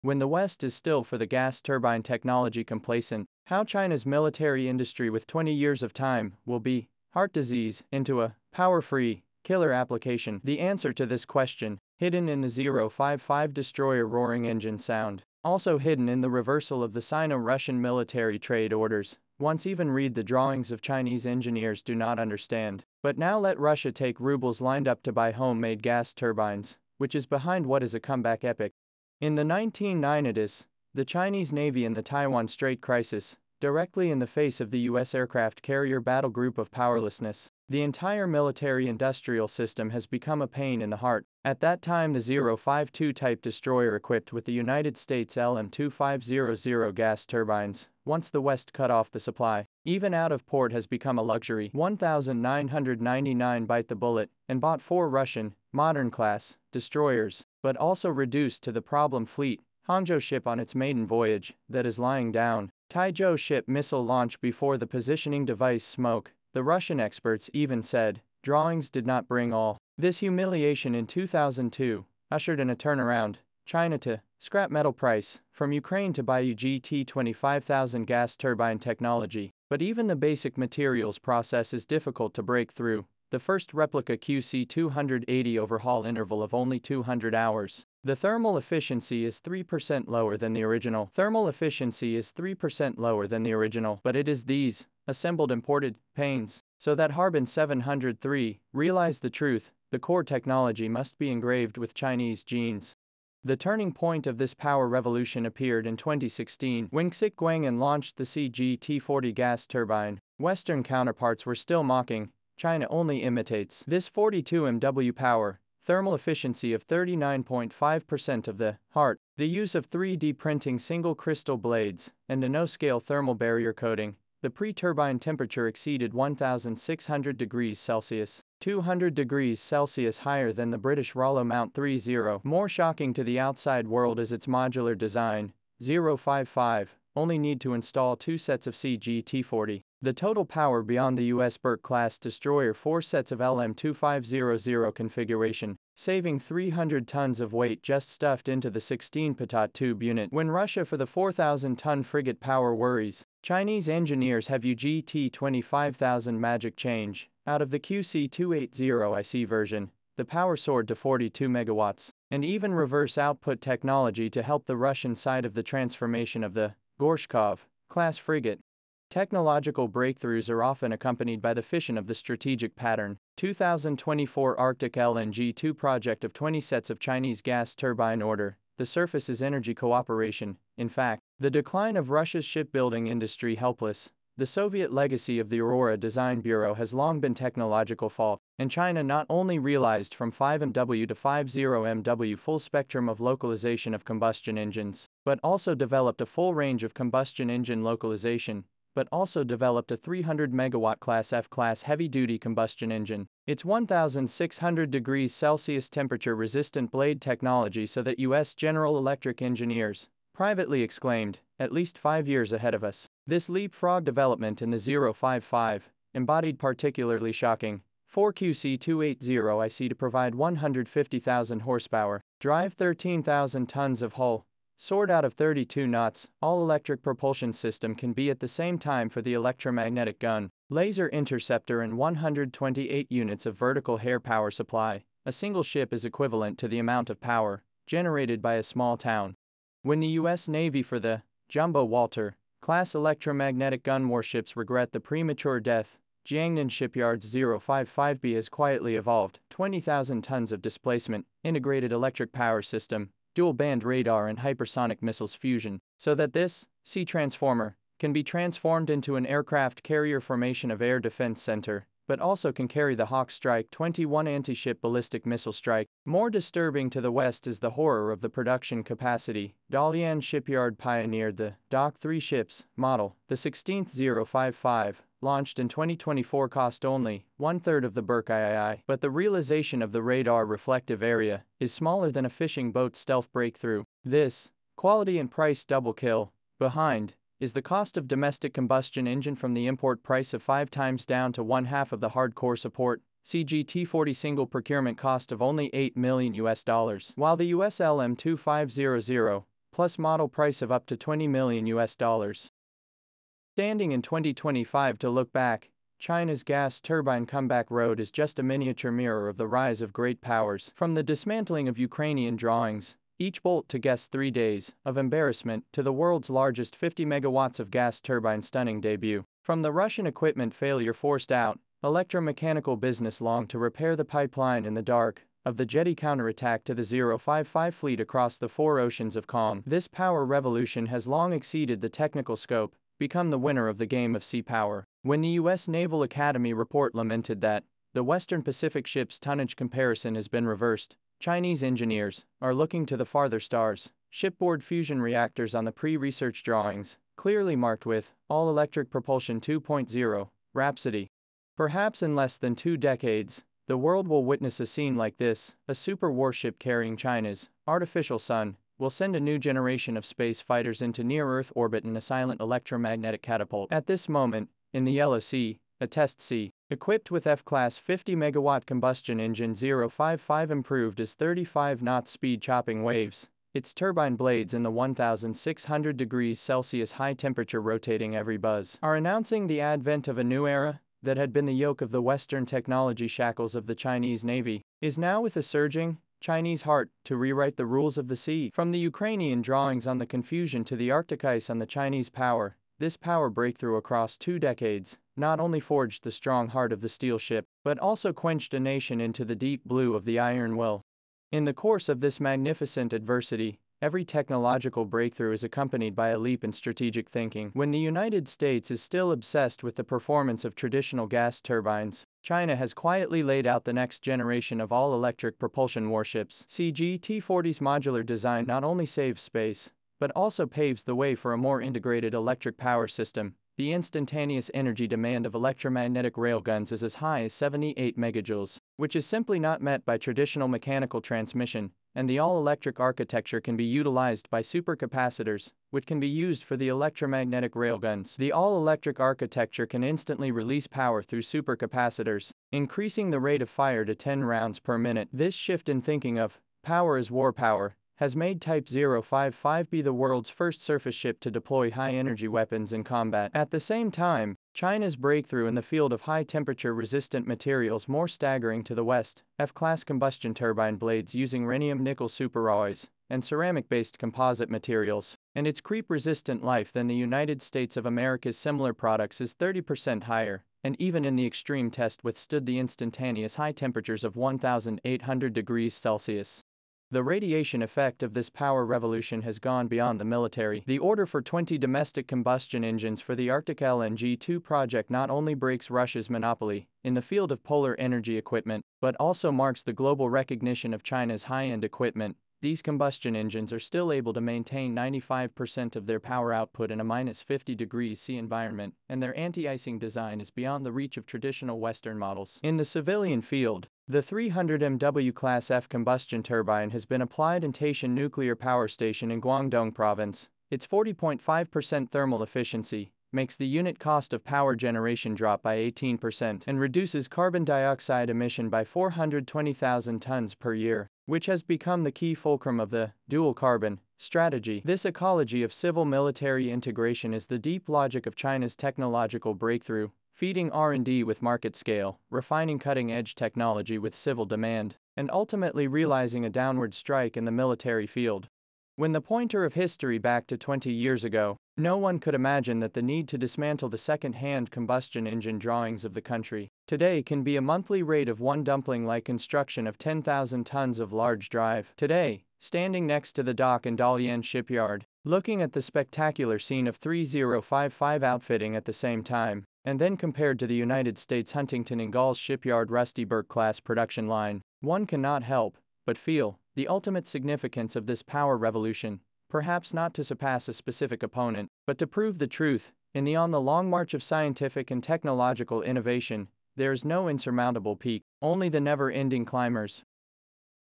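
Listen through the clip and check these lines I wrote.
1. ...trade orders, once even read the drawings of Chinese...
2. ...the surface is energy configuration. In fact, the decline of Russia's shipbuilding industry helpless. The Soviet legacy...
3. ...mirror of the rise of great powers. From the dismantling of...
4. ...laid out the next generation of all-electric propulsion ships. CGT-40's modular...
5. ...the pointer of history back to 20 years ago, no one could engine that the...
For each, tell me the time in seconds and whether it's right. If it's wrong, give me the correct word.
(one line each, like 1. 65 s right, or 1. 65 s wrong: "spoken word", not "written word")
1. 18 s right
2. 178 s wrong: "cooperation", not "configuration"
3. 308 s right
4. 413 s wrong: "warships", not "ships"
5. 538 s wrong: "imagine", not "engine".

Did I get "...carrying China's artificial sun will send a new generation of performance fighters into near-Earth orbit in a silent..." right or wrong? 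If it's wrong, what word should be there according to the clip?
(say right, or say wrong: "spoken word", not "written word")
wrong: "space", not "performance".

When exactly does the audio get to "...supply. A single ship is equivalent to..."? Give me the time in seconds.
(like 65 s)
234 s.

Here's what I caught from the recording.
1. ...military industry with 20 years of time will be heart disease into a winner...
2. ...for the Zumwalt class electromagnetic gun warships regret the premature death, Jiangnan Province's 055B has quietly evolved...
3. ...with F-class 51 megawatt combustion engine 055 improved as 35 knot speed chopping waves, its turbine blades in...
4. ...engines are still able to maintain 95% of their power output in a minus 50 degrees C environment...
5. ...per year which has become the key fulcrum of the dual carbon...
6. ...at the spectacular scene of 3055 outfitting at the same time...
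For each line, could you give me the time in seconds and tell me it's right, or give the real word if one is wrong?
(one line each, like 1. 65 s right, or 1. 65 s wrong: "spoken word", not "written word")
1. 4 s wrong: "power", not "winner"
2. 240 s wrong: "Shipyard", not "Province"
3. 367 s wrong: "50", not "51"
4. 493 s right
5. 520 s right
6. 555 s right.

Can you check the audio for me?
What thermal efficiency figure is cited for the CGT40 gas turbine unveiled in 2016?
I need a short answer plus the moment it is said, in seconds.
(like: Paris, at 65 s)
39.5%, at 116 s.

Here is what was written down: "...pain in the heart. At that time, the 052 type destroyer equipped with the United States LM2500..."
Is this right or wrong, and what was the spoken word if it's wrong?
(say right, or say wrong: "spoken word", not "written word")
right.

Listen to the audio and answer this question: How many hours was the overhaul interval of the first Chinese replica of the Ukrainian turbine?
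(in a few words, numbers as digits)
200 hours.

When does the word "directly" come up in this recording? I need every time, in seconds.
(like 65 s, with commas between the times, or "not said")
33 s.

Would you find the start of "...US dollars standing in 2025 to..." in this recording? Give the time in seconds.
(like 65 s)
301 s.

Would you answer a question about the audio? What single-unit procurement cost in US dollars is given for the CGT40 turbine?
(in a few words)
8 million US dollars.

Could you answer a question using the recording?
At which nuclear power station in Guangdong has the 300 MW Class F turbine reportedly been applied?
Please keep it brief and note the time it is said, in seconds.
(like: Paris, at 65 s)
Taishan, at 507 s.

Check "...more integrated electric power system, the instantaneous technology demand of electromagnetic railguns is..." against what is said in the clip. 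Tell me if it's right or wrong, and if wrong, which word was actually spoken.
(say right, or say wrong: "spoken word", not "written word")
wrong: "energy", not "technology".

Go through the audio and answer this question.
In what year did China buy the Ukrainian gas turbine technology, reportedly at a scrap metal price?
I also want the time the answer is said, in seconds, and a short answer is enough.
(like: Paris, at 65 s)
2002, at 71 s.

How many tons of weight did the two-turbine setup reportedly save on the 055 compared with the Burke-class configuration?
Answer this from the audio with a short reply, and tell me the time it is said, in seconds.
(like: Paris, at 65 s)
300 tons, at 146 s.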